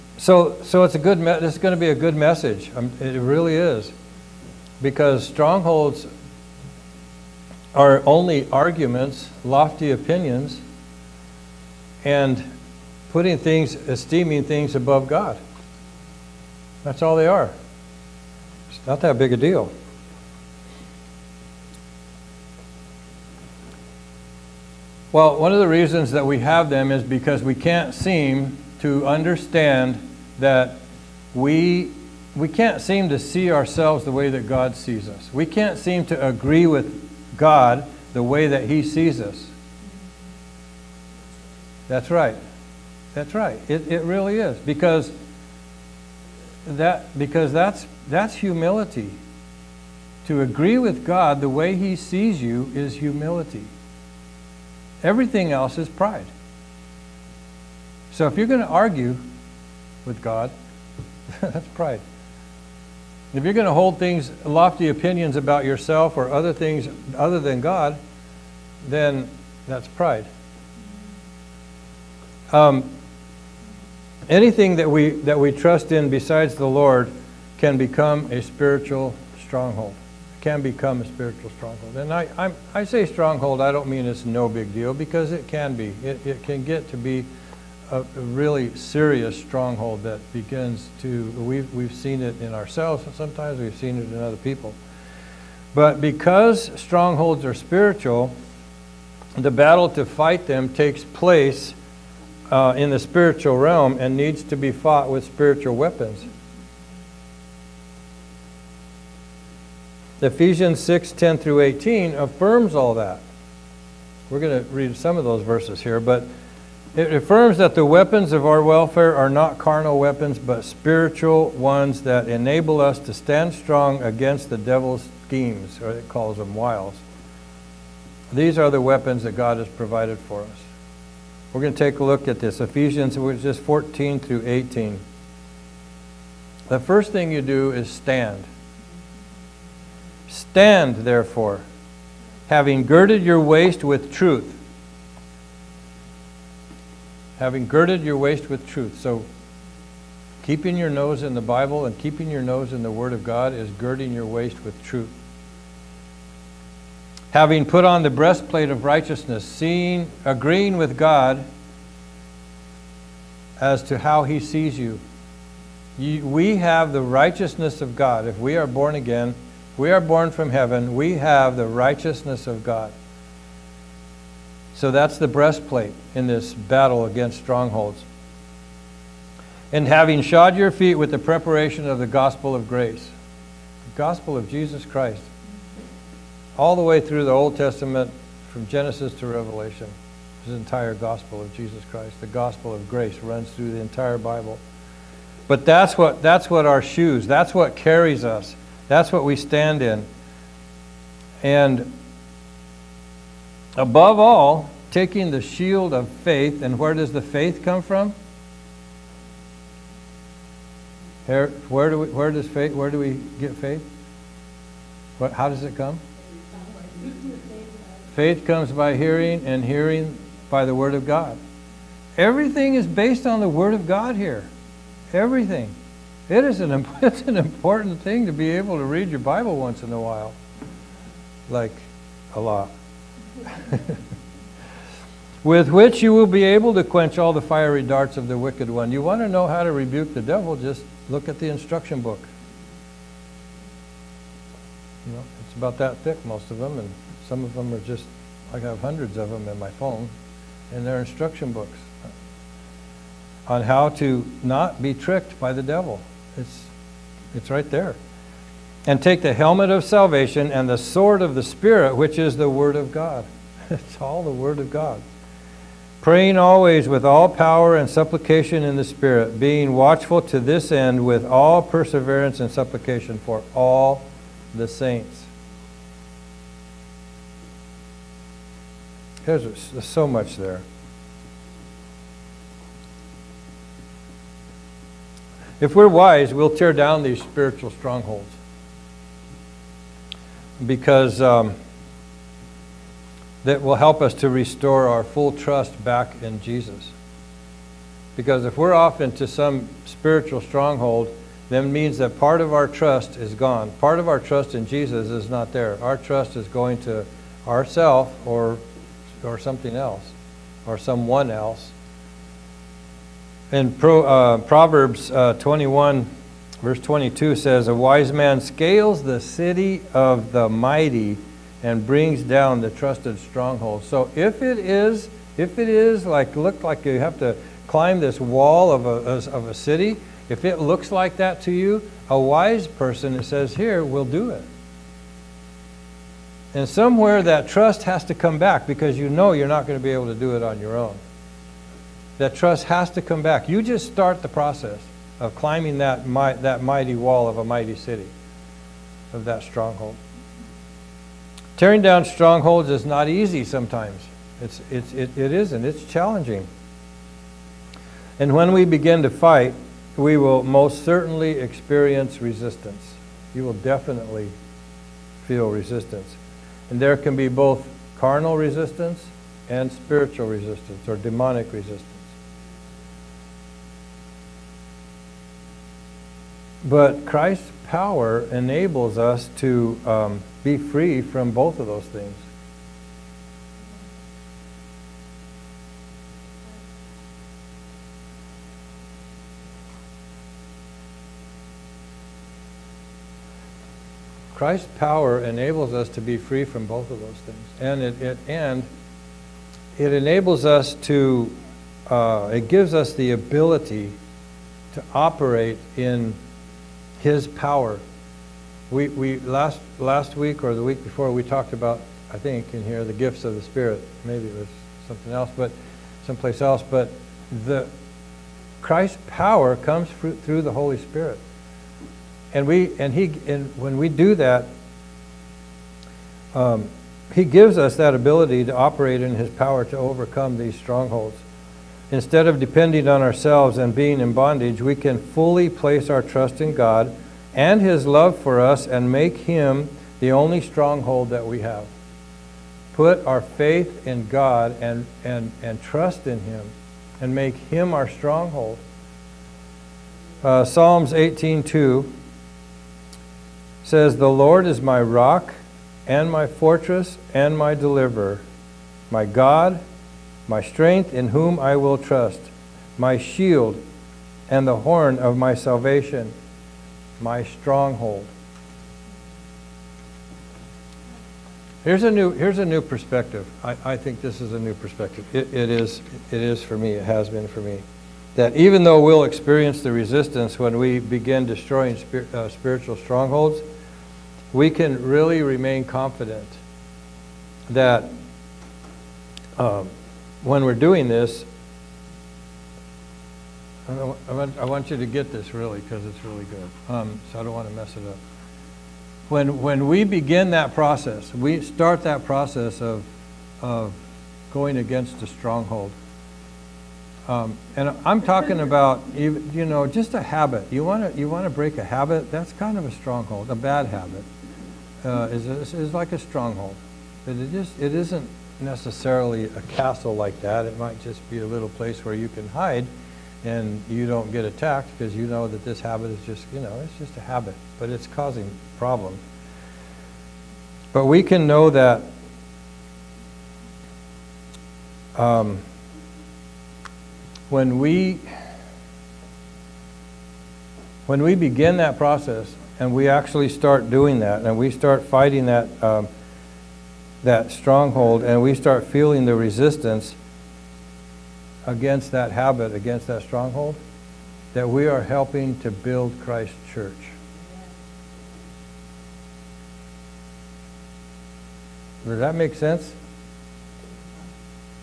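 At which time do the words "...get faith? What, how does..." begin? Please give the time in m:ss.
3:33.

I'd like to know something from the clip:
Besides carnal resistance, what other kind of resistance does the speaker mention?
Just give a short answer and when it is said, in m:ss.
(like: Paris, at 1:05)
demonic resistance, at 6:10.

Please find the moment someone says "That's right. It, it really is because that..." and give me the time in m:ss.
0:43.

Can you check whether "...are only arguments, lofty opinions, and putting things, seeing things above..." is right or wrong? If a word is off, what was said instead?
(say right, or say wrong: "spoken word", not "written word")
wrong: "esteeming", not "seeing".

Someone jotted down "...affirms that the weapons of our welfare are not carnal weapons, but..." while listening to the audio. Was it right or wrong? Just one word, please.
right.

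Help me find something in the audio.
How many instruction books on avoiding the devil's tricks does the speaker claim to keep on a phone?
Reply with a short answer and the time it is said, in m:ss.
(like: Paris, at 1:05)
hundreds, at 4:08.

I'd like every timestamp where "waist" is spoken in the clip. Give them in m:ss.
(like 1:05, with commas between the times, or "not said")
2:23, 2:28, 2:34.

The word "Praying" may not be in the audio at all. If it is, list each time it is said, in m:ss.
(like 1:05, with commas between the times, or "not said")
4:26.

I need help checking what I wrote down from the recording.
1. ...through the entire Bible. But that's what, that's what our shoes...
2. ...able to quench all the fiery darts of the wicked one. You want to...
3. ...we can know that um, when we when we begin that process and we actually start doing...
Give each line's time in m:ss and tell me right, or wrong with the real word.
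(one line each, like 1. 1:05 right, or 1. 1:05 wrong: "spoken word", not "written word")
1. 3:13 right
2. 3:56 right
3. 8:50 right.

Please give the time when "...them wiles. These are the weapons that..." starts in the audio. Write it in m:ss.
2:06.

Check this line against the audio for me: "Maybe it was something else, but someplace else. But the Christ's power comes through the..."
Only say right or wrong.
right.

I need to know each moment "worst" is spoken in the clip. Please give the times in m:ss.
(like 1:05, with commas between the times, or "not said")
not said.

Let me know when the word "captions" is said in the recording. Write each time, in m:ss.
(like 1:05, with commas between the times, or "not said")
not said.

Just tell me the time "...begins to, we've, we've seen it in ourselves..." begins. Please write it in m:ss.
1:30.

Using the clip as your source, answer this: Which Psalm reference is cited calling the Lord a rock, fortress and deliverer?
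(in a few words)
Psalms 18:2.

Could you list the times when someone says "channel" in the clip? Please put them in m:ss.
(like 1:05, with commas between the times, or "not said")
not said.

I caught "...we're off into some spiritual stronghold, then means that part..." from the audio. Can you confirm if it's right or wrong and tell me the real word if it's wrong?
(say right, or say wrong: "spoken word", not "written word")
right.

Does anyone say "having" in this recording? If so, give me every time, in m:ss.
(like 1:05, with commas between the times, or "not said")
2:22, 2:27, 2:37, 2:59.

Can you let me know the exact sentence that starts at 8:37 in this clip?
it just it isn't necessarily a castle like that.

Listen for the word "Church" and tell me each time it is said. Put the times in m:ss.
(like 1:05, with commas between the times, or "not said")
9:16.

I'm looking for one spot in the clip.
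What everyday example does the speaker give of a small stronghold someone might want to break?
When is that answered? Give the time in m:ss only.
8:33.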